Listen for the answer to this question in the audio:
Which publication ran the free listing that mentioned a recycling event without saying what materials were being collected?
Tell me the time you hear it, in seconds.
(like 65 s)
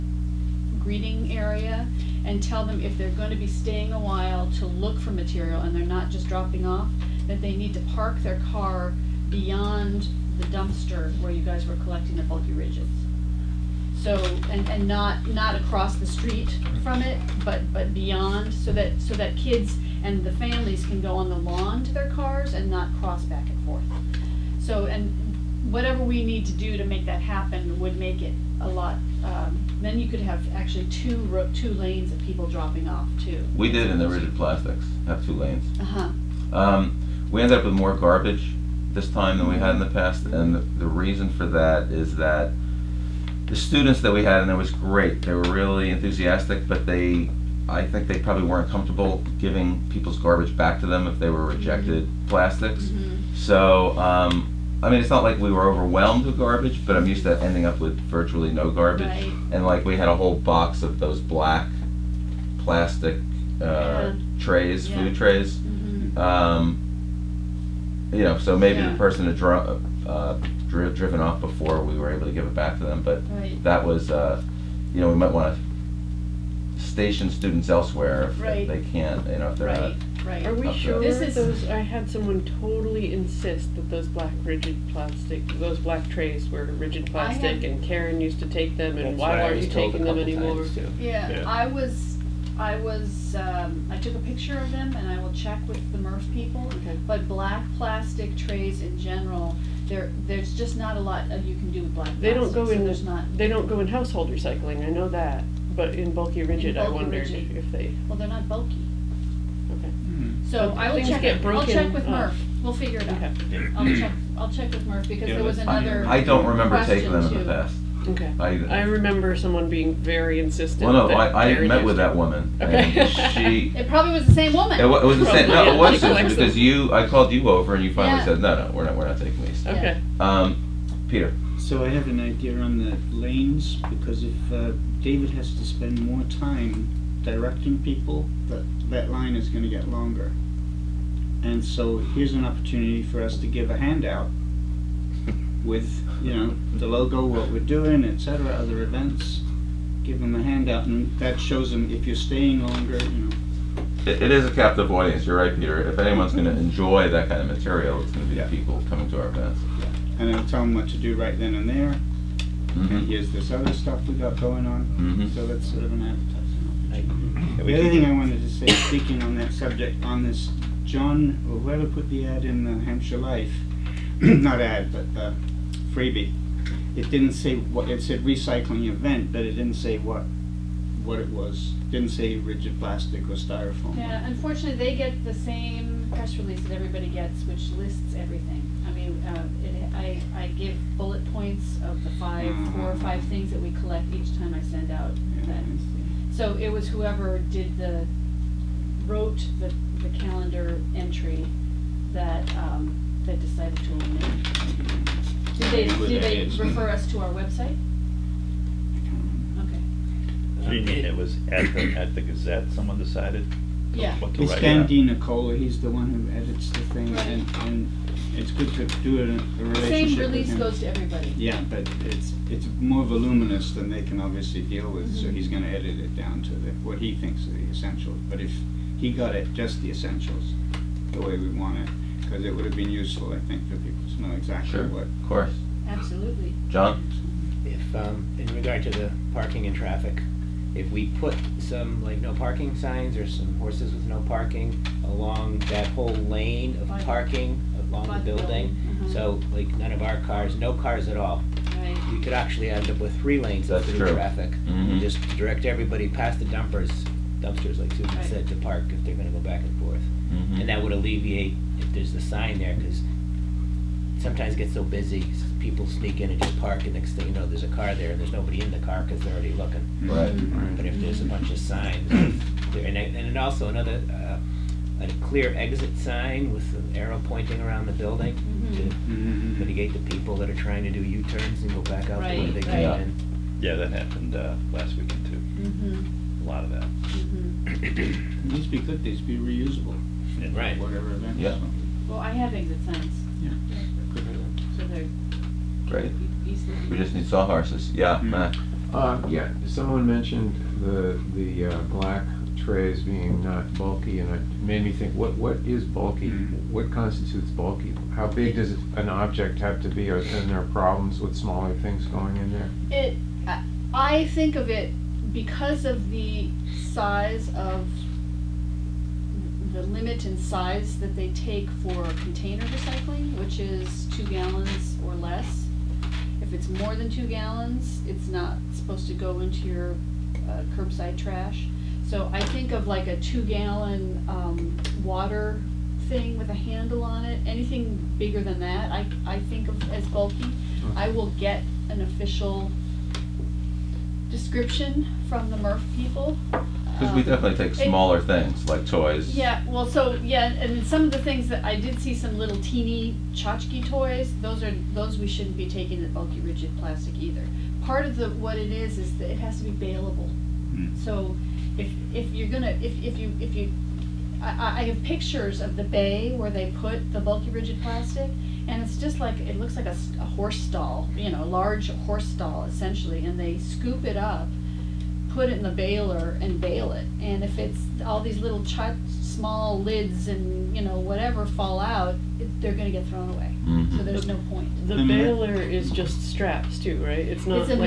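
172 s.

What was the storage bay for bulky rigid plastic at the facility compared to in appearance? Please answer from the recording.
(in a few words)
a horse stall.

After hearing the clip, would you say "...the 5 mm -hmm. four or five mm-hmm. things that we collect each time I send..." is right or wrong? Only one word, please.
right.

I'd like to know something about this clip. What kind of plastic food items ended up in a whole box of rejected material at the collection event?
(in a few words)
black plastic trays.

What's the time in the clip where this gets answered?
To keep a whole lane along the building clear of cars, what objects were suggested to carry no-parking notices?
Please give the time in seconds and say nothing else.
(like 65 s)
243 s.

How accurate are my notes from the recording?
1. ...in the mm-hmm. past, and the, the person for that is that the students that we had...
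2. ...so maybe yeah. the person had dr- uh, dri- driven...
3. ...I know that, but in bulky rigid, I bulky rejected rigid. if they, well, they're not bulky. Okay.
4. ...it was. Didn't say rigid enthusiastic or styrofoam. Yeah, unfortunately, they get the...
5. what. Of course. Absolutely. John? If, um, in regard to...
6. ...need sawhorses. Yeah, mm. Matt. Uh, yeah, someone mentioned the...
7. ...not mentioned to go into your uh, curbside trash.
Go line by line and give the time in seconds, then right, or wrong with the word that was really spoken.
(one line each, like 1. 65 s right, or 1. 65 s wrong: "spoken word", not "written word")
1. 39 s wrong: "reason", not "person"
2. 68 s right
3. 104 s wrong: "wondered", not "rejected"
4. 181 s wrong: "plastic", not "enthusiastic"
5. 234 s right
6. 297 s right
7. 328 s wrong: "supposed", not "mentioned".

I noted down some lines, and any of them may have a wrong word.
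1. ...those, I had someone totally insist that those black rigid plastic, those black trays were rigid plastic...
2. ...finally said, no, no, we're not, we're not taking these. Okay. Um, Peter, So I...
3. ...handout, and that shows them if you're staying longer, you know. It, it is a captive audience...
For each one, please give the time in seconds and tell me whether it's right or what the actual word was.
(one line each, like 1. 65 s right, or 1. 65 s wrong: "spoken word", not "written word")
1. 81 s right
2. 127 s right
3. 150 s right.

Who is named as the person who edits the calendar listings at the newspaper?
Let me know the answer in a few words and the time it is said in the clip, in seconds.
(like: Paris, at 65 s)
Dan Nicola, at 214 s.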